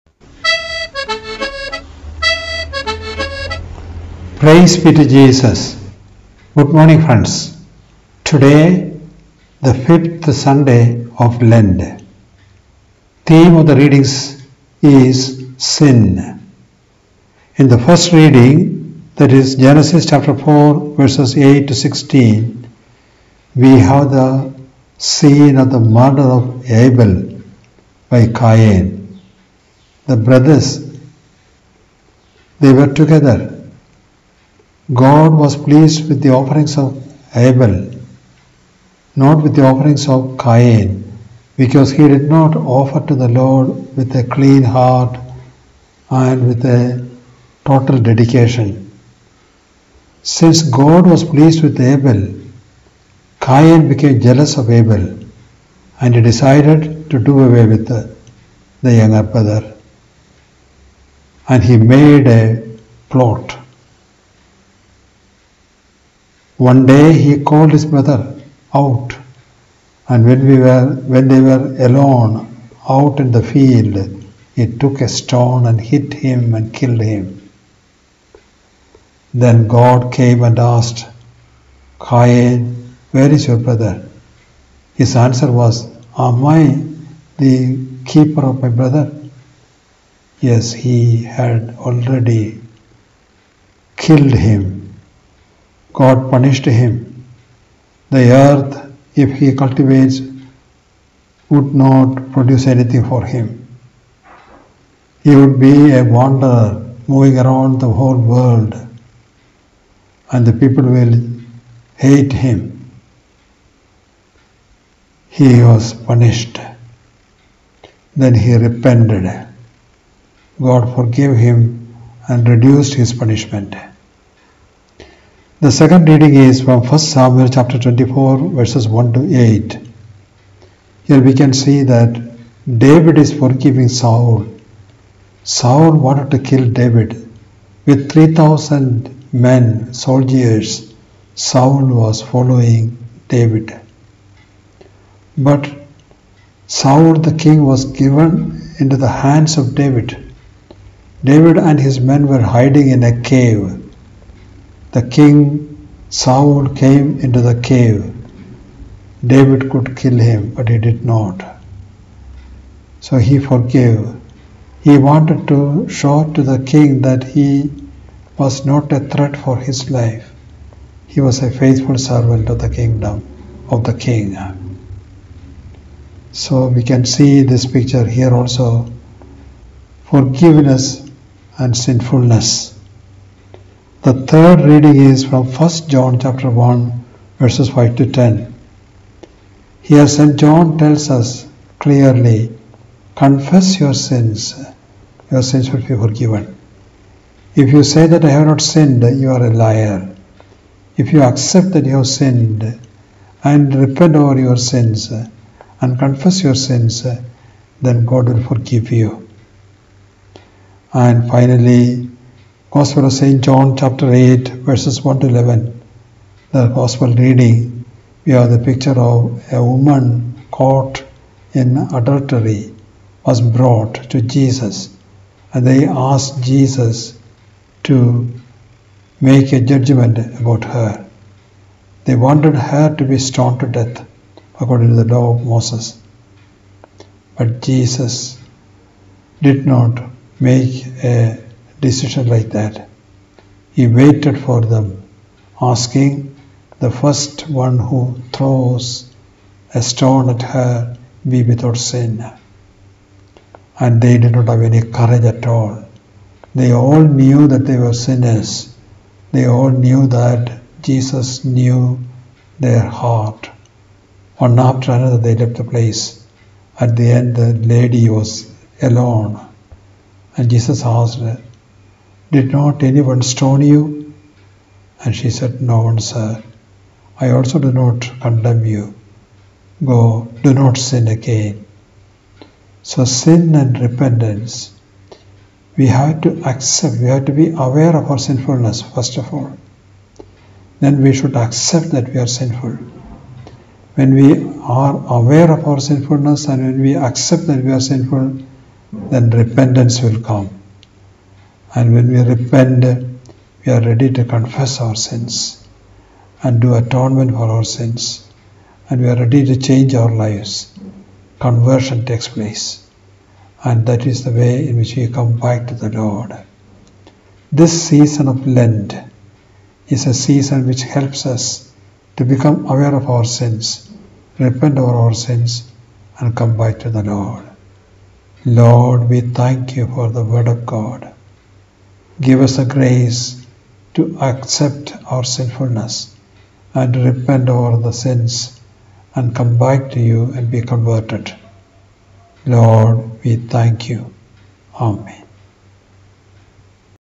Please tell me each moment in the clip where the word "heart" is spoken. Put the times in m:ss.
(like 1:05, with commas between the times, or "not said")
0:44, 4:22.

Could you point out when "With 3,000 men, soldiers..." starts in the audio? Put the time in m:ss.
2:17.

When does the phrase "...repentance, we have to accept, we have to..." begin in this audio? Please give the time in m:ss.
4:43.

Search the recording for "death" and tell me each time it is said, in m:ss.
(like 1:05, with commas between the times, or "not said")
3:53.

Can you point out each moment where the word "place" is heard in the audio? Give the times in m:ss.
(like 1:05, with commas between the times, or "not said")
4:25, 5:12.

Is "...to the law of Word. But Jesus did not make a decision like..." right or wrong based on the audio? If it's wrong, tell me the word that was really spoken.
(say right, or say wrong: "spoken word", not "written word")
wrong: "Moses", not "Word".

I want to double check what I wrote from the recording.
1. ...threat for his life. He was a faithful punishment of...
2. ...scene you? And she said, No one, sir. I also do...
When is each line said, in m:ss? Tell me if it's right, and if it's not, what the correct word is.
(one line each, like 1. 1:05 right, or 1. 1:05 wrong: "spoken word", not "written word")
1. 2:49 wrong: "servant", not "punishment"
2. 4:33 wrong: "stone", not "scene".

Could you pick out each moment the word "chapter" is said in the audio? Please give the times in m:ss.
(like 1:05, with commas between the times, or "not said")
0:20, 2:07, 3:06, 3:33.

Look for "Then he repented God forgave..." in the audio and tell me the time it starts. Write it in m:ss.
1:58.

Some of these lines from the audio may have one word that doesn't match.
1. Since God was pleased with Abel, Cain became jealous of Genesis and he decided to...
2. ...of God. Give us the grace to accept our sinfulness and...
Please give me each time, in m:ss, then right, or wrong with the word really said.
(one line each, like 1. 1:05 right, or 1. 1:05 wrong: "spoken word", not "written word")
1. 0:50 wrong: "Abel", not "Genesis"
2. 5:30 right.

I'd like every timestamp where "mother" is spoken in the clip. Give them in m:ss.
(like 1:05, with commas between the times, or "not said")
1:07.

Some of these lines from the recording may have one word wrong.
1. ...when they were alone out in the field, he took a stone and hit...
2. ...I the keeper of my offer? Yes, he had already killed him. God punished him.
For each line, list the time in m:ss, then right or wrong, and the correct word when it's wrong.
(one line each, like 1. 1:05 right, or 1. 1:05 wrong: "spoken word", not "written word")
1. 1:11 right
2. 1:26 wrong: "brother", not "offer".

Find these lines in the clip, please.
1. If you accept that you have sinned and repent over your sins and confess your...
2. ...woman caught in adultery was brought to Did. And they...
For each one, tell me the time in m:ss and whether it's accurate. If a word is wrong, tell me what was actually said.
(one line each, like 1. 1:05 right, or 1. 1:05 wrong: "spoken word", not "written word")
1. 3:20 right
2. 3:39 wrong: "Jesus", not "Did".